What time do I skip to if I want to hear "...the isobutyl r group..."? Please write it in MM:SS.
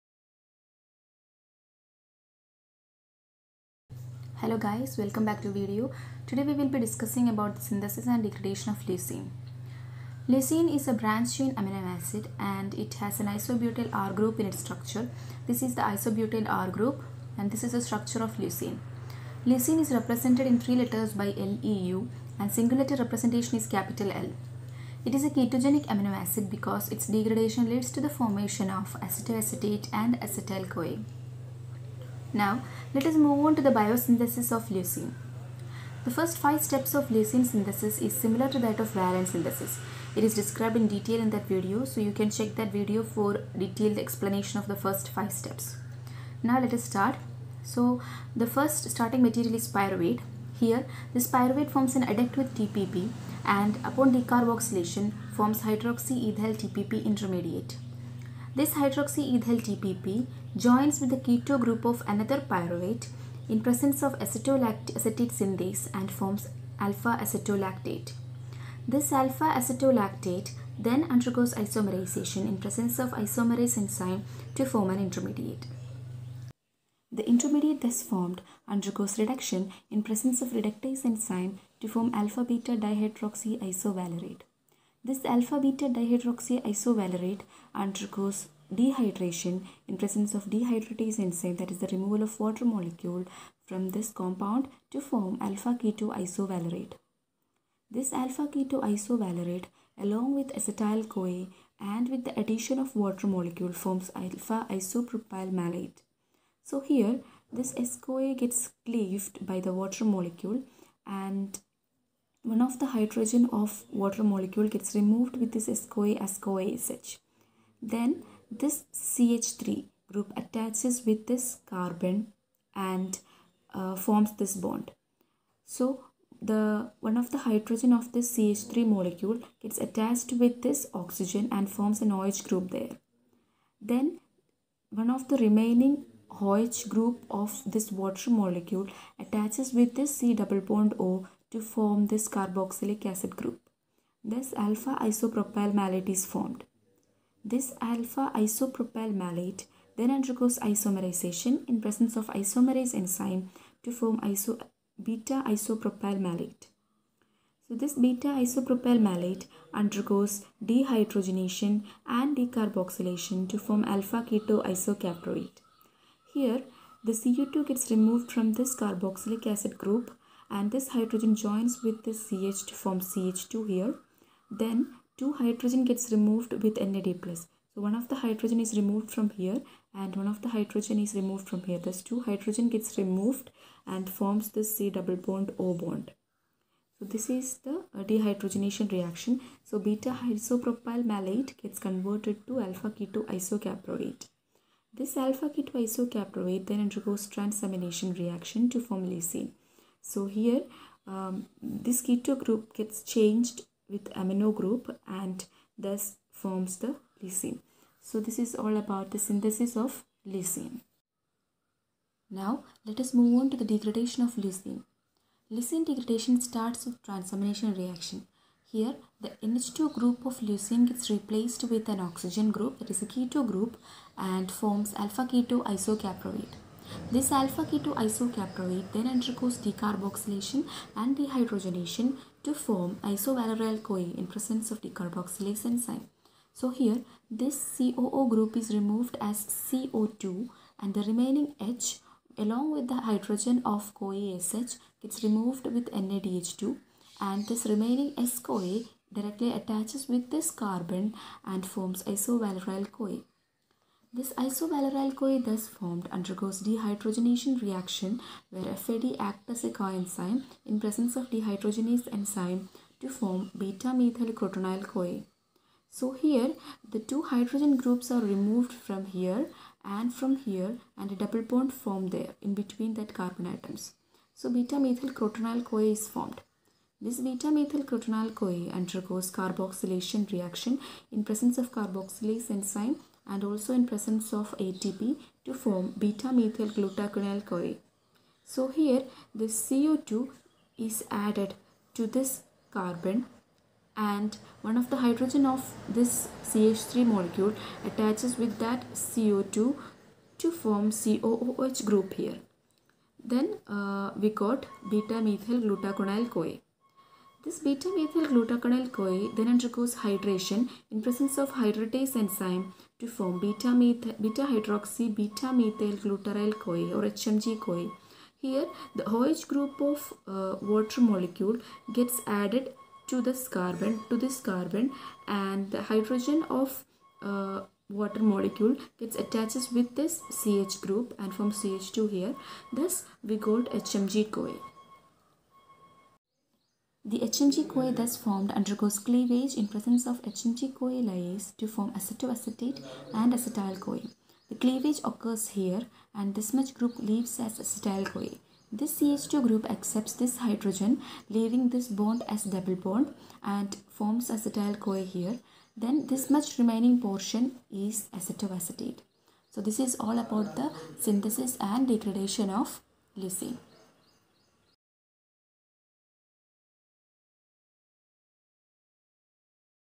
00:15.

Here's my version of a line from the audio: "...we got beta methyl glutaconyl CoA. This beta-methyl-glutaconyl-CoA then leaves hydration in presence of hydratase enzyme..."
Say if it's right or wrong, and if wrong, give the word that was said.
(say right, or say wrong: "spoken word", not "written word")
wrong: "undergoes", not "leaves".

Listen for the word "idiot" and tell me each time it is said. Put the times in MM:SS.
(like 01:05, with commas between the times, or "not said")
not said.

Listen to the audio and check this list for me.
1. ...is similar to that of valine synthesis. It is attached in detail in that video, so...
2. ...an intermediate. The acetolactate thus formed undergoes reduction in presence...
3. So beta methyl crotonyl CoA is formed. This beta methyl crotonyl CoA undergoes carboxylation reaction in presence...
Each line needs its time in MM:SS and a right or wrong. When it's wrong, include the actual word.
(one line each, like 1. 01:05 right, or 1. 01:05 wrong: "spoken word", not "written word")
1. 00:38 wrong: "described", not "attached"
2. 01:14 wrong: "intermediate", not "acetolactate"
3. 04:34 right.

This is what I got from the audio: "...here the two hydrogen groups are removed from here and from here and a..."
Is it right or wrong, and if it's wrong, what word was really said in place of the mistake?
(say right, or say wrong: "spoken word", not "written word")
right.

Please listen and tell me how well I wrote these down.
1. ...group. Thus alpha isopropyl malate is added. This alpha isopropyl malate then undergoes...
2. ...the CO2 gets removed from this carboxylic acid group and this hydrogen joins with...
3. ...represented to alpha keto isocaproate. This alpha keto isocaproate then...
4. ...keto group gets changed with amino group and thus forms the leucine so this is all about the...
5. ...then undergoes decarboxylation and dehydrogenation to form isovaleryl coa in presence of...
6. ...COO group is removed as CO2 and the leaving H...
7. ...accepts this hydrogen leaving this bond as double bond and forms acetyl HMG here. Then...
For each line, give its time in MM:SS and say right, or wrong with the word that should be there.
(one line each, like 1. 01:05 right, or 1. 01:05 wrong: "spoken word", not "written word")
1. 02:23 wrong: "formed", not "added"
2. 02:47 right
3. 03:11 wrong: "converted", not "represented"
4. 03:22 right
5. 03:48 right
6. 03:57 wrong: "remaining", not "leaving"
7. 05:49 wrong: "CoA", not "HMG".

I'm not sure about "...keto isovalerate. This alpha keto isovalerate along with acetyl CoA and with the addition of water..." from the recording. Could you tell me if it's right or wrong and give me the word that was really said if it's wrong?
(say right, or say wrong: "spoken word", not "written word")
right.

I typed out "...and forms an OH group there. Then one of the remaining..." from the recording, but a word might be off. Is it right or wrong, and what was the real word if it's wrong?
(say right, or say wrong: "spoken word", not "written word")
right.